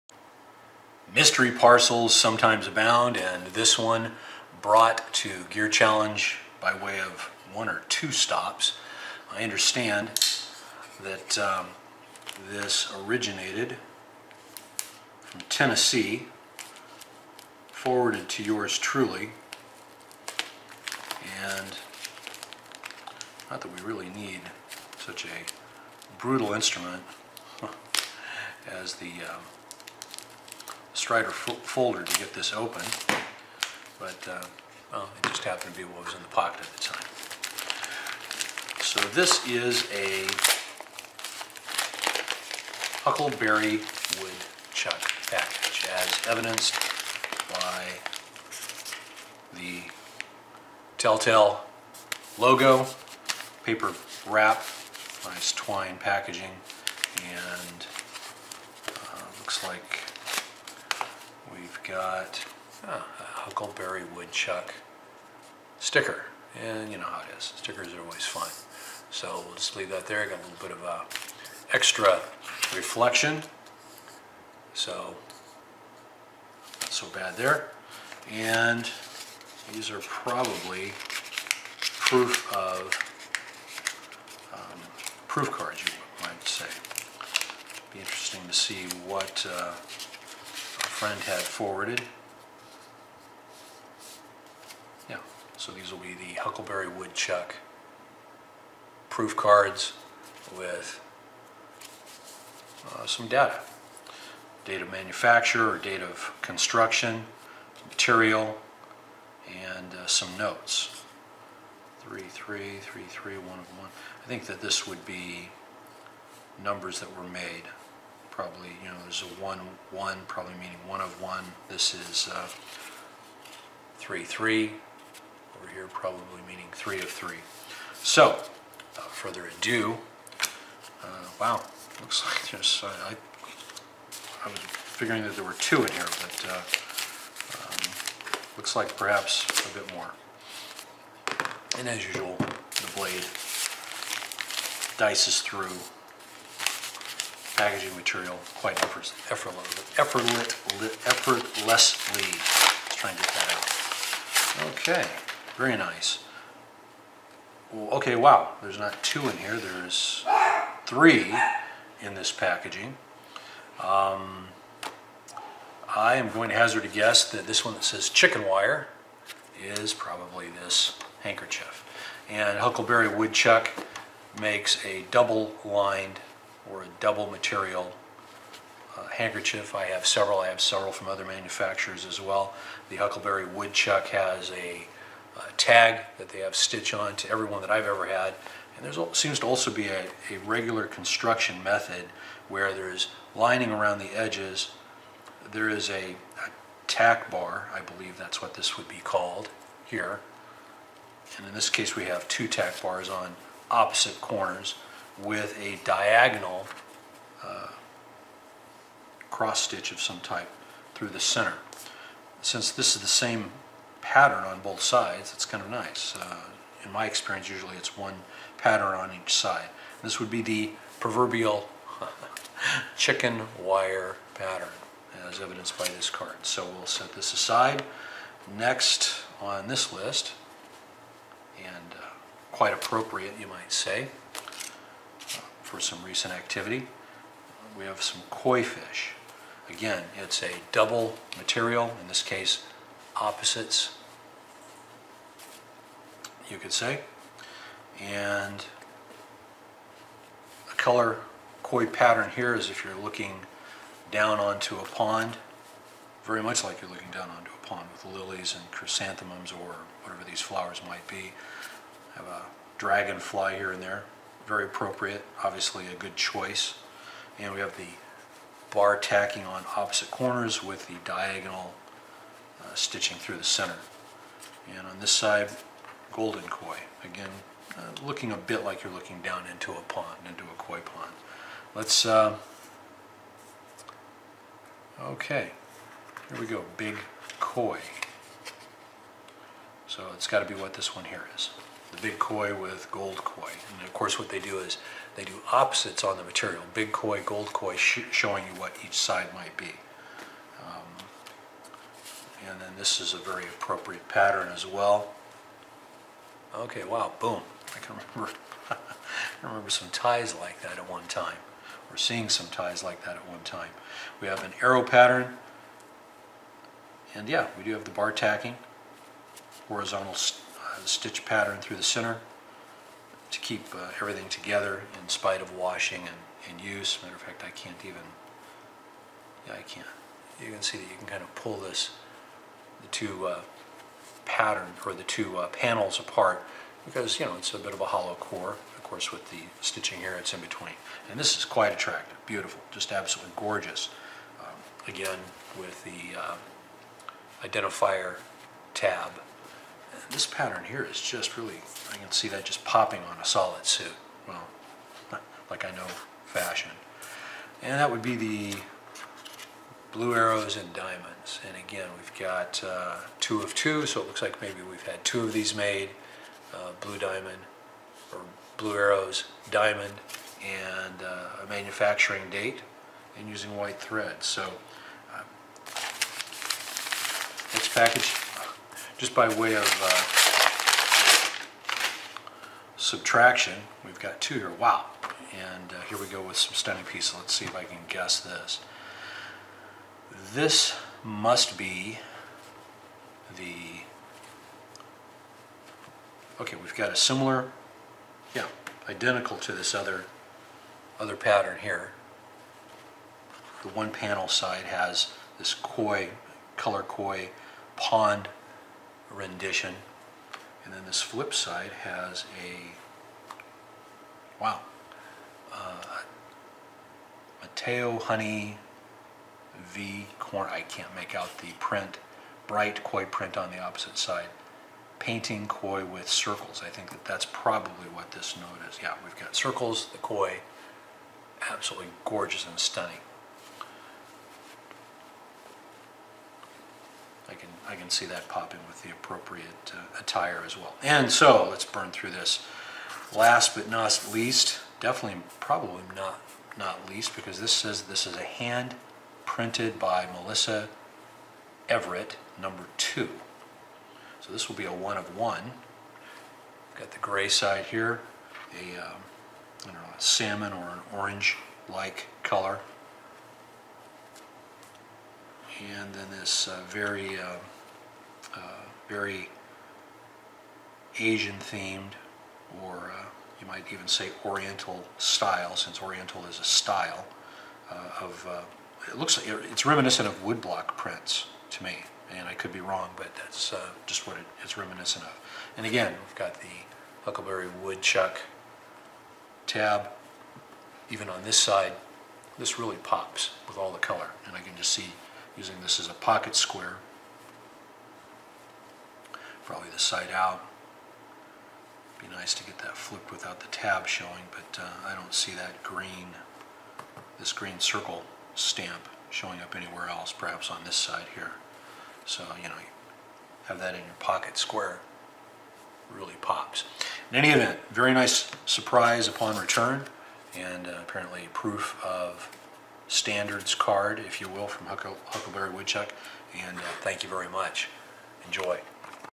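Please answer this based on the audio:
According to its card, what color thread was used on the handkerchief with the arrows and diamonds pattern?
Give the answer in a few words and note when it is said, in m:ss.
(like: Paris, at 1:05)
White, at 6:13.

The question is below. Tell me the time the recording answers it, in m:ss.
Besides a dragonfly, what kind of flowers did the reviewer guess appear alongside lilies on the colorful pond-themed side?
4:18.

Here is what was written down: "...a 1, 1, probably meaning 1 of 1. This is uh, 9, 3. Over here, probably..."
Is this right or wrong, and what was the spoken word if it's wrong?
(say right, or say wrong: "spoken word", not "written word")
wrong: "3", not "9".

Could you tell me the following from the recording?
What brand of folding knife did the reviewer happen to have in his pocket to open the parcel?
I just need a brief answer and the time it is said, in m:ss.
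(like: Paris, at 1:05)
Strider, at 0:30.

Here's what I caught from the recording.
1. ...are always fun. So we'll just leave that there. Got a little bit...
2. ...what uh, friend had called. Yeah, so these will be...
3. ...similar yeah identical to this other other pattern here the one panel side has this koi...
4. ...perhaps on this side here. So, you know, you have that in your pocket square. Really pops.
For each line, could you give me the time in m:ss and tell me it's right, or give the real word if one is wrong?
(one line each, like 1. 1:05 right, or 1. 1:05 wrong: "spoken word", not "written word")
1. 1:07 right
2. 1:29 wrong: "forwarded", not "called"
3. 6:36 right
4. 8:30 right.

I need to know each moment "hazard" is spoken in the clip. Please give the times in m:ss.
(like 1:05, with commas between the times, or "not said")
2:46.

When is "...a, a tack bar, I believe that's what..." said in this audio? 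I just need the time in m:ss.
3:15.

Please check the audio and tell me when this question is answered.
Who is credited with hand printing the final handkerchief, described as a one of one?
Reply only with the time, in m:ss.
7:30.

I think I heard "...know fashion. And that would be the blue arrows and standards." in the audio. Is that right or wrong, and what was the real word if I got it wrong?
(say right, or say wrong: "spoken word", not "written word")
wrong: "diamonds", not "standards".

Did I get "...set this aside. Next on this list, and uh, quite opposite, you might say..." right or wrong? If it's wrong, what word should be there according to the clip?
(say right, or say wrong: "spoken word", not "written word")
wrong: "appropriate", not "opposite".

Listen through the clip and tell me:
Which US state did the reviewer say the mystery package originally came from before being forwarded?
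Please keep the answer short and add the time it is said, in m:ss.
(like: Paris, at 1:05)
Tennessee, at 0:15.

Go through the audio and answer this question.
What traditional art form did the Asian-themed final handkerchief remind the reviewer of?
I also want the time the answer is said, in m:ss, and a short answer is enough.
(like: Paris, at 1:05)
Woodblock prints, at 8:00.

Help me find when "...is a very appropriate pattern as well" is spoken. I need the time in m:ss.
5:03.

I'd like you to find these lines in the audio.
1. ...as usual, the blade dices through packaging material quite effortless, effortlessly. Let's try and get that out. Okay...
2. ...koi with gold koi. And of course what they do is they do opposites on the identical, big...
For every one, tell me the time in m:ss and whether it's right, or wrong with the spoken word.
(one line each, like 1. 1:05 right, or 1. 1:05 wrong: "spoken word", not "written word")
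1. 2:21 right
2. 4:52 wrong: "material", not "identical".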